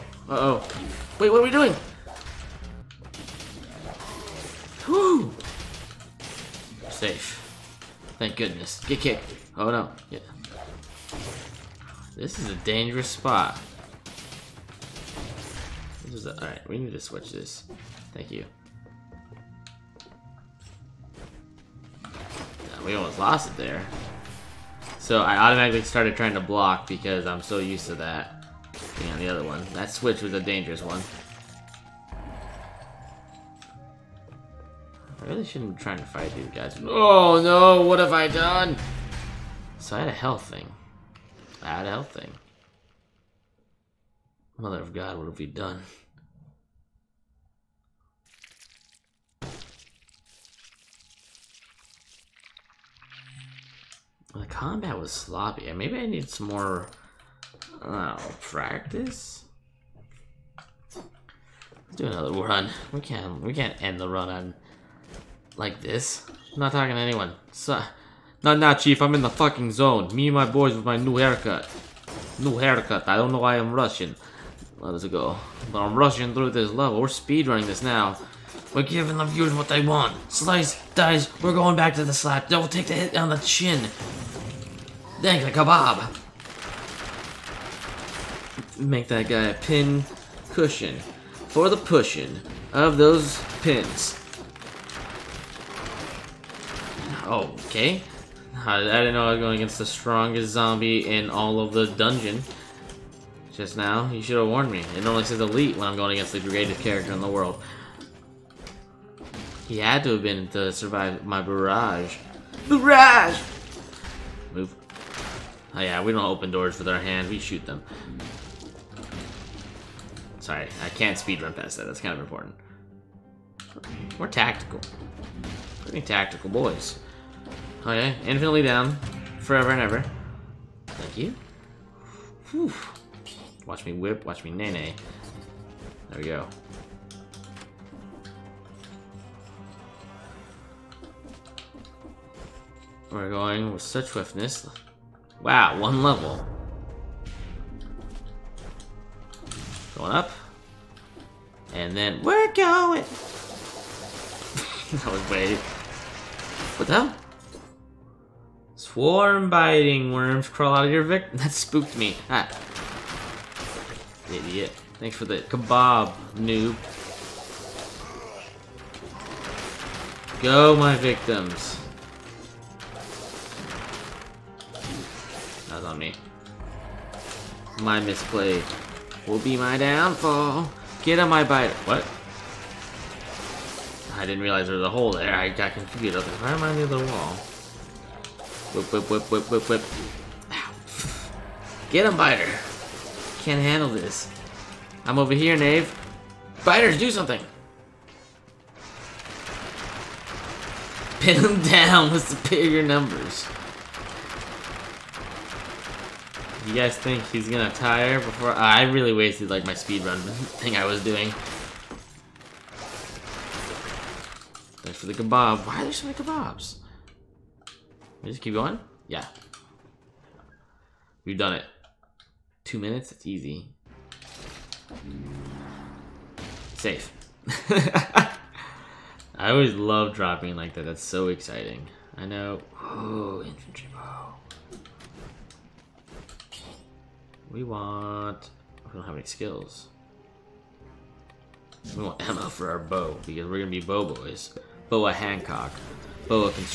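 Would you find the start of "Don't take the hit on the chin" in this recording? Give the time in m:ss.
1:22.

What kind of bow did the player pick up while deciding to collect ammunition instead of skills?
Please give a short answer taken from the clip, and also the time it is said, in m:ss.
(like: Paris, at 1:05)
Infantry bow, at 3:53.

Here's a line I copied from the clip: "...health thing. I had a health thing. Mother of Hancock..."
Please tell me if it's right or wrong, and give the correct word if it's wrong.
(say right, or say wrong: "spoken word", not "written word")
wrong: "God", not "Hancock".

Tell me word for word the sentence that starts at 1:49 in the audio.
He had to have been to survive my barrage.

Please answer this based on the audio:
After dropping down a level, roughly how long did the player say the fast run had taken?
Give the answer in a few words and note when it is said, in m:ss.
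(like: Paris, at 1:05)
2 minutes, at 3:42.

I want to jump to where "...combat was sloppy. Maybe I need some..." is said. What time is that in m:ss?
0:54.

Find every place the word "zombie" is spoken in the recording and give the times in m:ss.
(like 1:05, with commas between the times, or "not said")
1:40.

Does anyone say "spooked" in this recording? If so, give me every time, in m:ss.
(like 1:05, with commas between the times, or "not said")
2:41.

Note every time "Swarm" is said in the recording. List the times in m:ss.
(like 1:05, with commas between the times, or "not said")
2:38.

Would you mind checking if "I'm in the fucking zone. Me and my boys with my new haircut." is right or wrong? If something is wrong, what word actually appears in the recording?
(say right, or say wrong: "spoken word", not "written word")
right.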